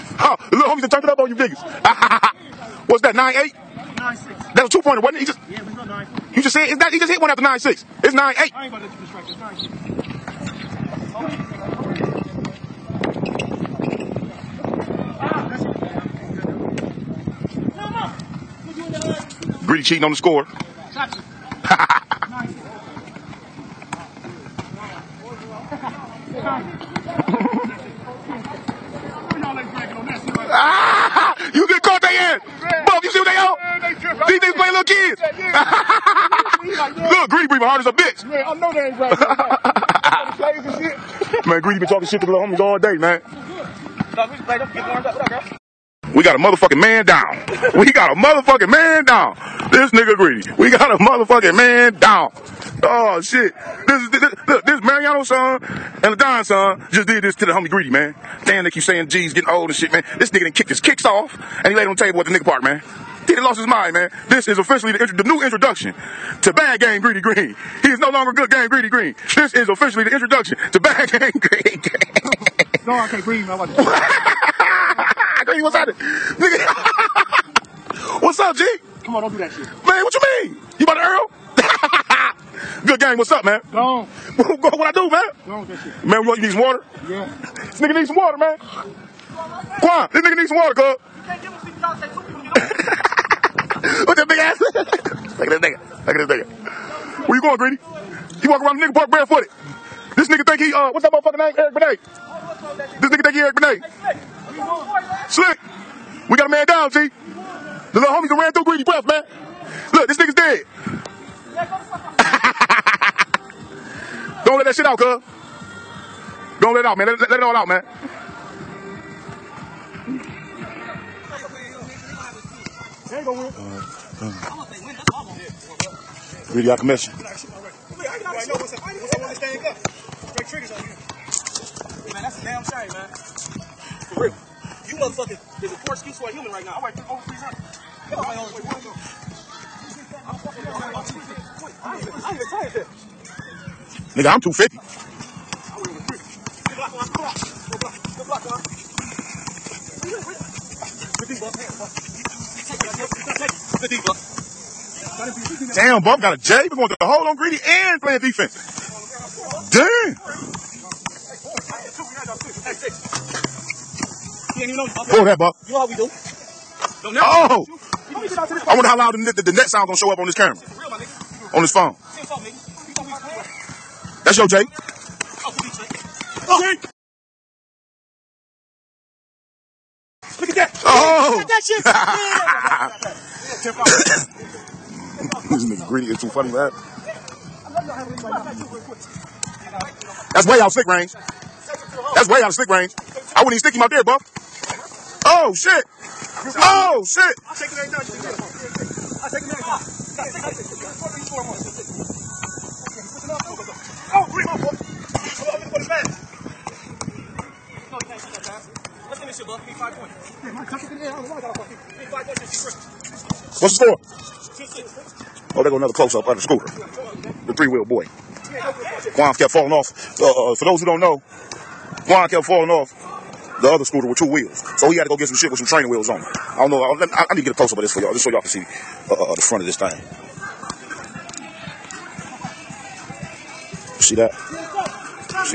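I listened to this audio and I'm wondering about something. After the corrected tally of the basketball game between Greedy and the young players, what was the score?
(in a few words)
9-8.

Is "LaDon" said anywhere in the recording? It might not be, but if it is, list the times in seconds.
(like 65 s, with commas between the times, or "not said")
56 s.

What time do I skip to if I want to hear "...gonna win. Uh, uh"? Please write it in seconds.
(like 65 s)
123 s.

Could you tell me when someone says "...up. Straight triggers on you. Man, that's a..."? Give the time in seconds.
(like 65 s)
129 s.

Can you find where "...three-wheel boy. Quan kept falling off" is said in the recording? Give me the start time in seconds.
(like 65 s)
217 s.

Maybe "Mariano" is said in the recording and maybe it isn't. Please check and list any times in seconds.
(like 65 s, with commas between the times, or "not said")
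54 s.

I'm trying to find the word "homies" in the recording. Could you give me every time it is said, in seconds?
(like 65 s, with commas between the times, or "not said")
0 s, 42 s, 57 s, 108 s.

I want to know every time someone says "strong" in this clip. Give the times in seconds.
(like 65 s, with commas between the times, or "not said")
not said.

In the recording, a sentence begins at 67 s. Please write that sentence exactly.
He is no longer good game Greedy Green.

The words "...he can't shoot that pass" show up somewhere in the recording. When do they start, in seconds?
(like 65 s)
207 s.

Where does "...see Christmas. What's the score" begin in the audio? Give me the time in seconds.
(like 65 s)
212 s.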